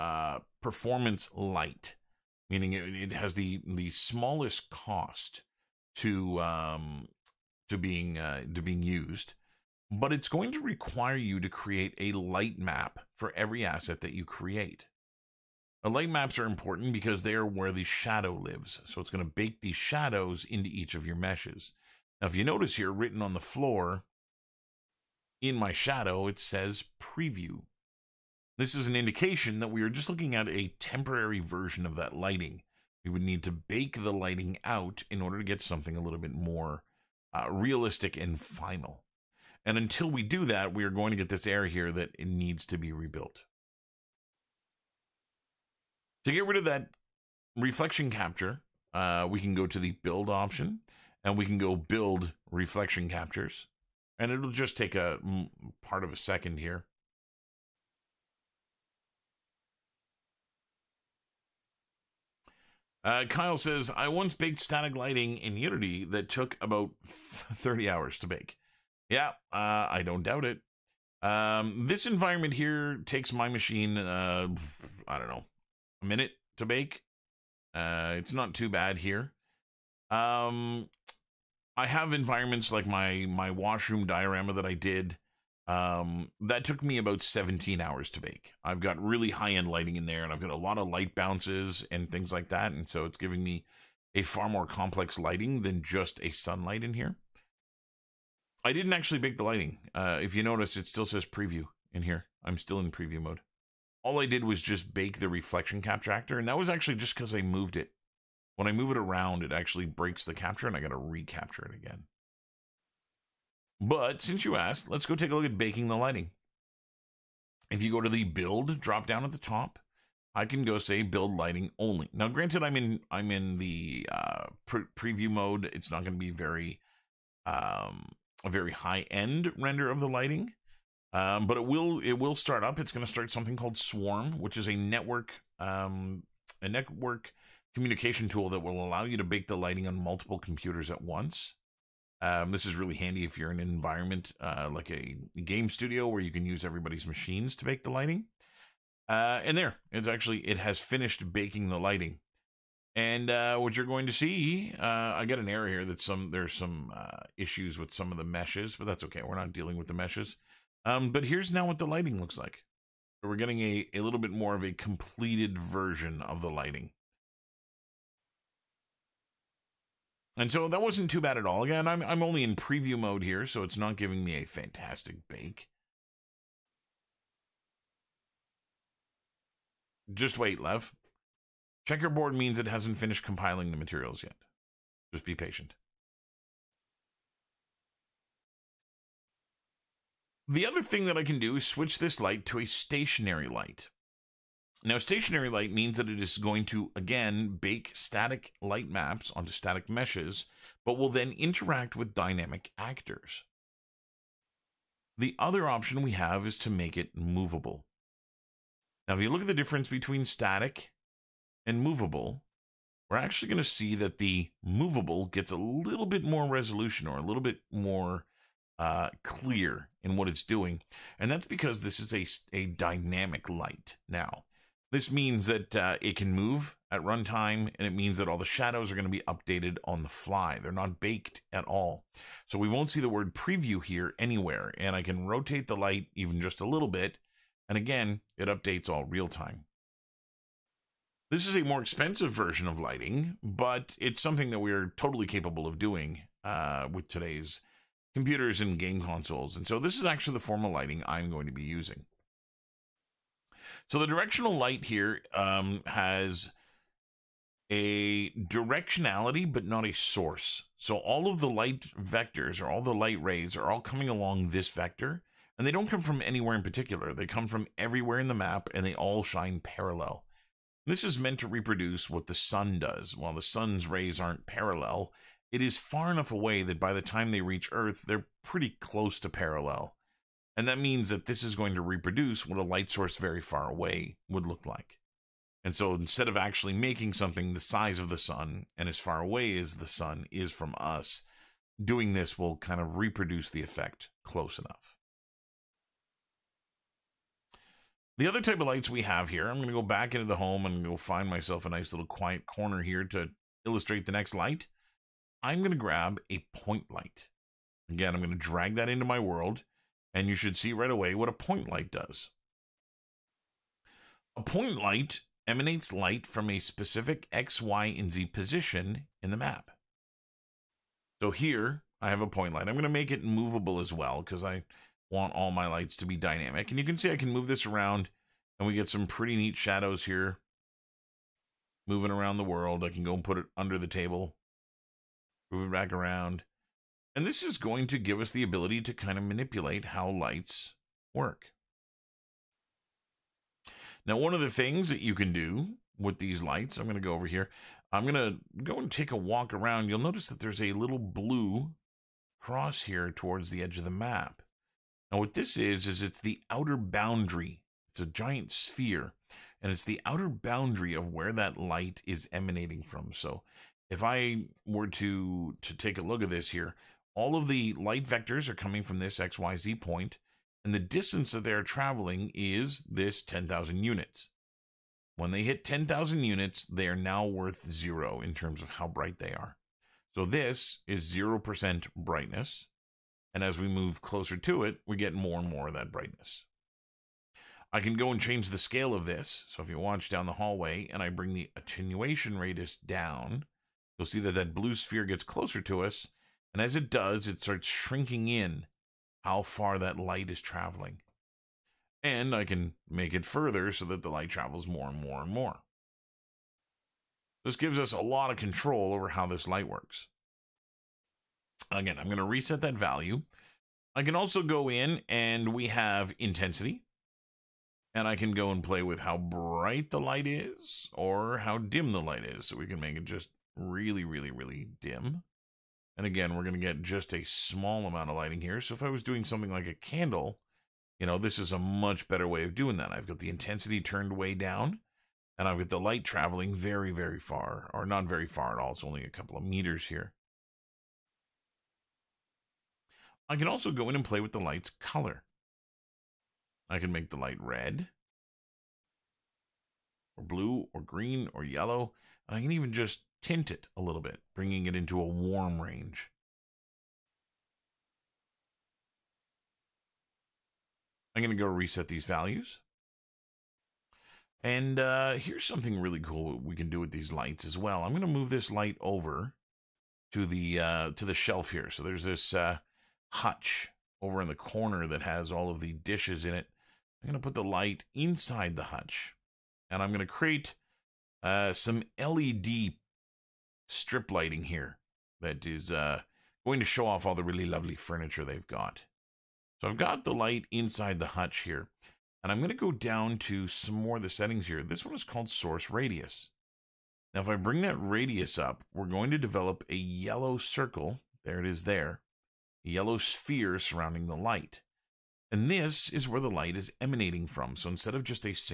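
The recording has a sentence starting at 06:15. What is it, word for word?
When they hit 10,000 units, they are now worth zero in terms of how bright they are.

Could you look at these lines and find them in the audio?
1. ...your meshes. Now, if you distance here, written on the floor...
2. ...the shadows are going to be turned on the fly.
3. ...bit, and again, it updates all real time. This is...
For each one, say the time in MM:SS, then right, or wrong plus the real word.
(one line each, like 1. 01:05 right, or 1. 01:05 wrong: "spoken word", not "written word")
1. 00:21 wrong: "notice", not "distance"
2. 03:48 wrong: "updated", not "turned"
3. 03:56 right.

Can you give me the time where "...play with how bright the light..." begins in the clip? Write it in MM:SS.
06:58.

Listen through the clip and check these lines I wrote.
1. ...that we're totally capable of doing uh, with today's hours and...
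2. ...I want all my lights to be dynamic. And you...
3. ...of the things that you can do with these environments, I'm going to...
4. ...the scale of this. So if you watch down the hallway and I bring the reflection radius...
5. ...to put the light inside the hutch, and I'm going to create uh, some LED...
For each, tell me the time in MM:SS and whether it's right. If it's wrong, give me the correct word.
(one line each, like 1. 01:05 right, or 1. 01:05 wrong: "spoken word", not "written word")
1. 04:04 wrong: "computers", not "hours"
2. 05:24 right
3. 05:44 wrong: "lights", not "environments"
4. 06:28 wrong: "attenuation", not "reflection"
5. 07:57 right.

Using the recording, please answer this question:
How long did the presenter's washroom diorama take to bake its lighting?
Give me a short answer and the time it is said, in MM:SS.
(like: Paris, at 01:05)
17 hours, at 01:27.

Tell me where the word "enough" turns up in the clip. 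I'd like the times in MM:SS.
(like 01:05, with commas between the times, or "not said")
04:36, 04:54.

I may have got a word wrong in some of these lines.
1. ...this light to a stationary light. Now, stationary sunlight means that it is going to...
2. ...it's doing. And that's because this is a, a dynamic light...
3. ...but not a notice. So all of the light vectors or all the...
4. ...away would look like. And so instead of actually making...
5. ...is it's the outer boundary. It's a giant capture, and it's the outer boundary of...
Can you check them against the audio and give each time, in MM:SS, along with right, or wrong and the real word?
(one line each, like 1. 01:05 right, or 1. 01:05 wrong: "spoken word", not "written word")
1. 03:11 wrong: "light", not "sunlight"
2. 03:40 right
3. 04:19 wrong: "source", not "notice"
4. 04:43 right
5. 05:55 wrong: "sphere", not "capture".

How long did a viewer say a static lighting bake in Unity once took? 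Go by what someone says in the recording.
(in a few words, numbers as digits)
30 hours.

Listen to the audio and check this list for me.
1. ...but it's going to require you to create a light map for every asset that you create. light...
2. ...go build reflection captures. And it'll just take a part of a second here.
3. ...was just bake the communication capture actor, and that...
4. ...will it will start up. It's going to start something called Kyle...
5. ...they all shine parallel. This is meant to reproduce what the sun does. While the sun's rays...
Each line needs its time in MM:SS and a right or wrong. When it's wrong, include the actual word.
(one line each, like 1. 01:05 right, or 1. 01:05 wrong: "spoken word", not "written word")
1. 00:09 right
2. 00:51 right
3. 01:44 wrong: "reflection", not "communication"
4. 02:11 wrong: "Swarm", not "Kyle"
5. 04:28 right.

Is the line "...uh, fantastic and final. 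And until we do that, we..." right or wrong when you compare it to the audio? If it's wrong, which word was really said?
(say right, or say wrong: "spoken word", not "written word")
wrong: "realistic", not "fantastic".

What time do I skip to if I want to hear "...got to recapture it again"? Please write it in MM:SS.
01:50.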